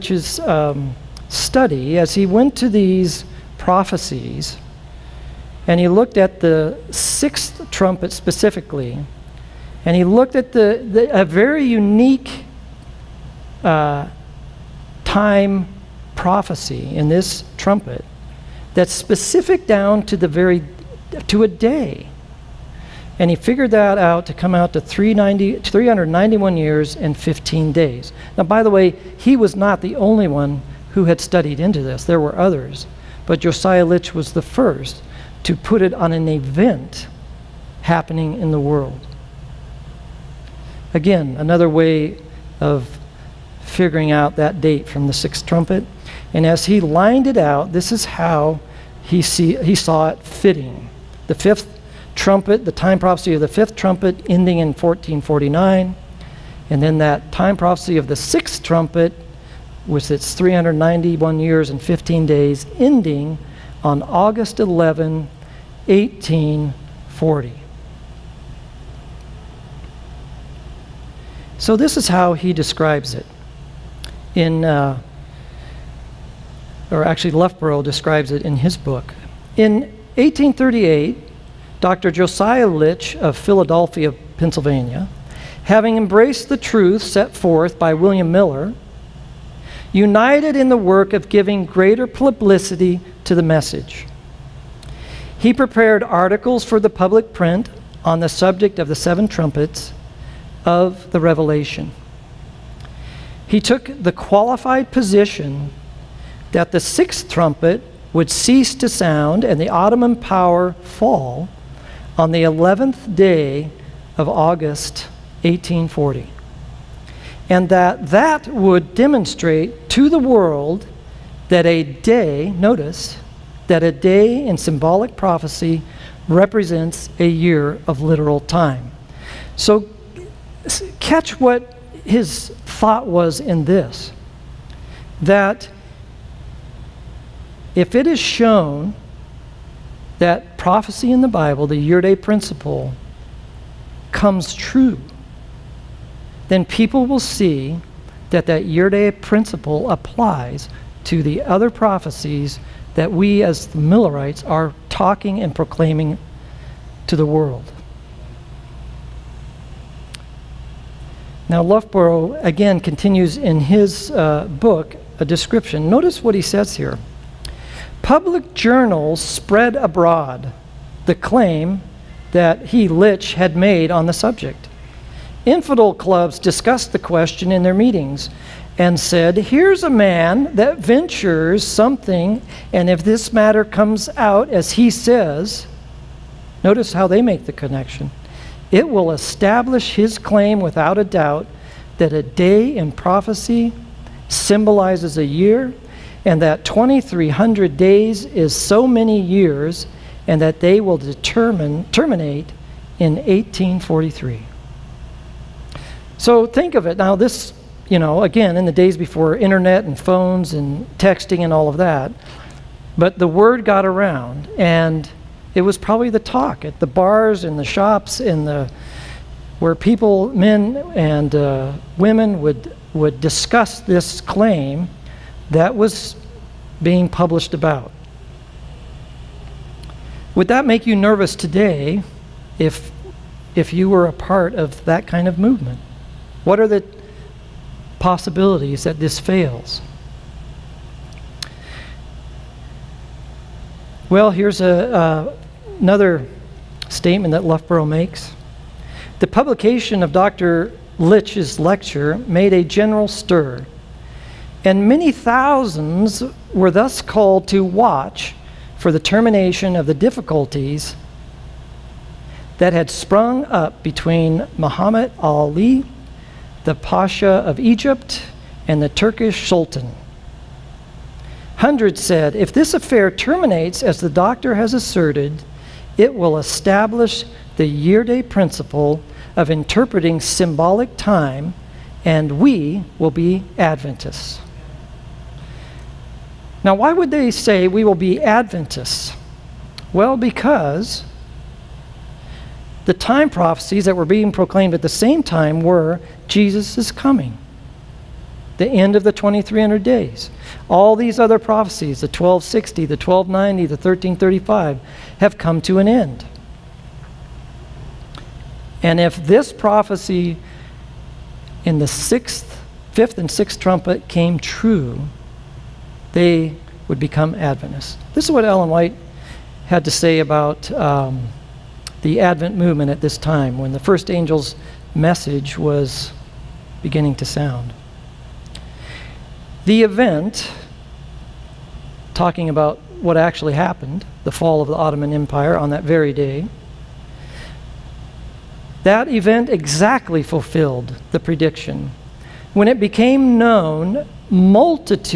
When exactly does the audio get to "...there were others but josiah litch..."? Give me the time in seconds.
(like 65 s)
32 s.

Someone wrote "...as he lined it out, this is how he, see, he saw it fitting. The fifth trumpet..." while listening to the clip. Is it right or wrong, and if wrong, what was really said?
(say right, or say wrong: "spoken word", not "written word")
right.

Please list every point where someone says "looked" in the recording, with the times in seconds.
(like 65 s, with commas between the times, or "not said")
5 s, 10 s.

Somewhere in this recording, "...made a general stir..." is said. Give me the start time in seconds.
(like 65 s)
252 s.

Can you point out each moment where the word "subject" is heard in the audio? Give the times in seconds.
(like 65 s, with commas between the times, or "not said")
98 s, 174 s.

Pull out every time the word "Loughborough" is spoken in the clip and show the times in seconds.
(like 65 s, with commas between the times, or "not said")
77 s, 161 s, 247 s.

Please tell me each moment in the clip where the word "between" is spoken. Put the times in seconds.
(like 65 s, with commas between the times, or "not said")
263 s.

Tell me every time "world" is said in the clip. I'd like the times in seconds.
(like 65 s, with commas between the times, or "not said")
38 s, 120 s, 157 s.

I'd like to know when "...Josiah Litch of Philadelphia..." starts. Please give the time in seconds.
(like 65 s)
82 s.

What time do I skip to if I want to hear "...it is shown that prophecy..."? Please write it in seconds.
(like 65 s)
137 s.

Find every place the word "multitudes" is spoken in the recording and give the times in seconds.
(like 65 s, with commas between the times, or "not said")
344 s.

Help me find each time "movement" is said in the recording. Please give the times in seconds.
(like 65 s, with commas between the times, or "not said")
235 s, 322 s.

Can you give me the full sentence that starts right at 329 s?
The event talking about what actually happened, the fall of the Ottoman Empire on that very day.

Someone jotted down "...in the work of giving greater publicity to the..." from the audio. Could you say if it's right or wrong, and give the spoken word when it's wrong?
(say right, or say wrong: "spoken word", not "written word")
right.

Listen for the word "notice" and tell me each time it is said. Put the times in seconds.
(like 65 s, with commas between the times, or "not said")
122 s, 165 s, 186 s.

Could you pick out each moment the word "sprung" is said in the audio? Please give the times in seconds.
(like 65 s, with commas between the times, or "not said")
262 s.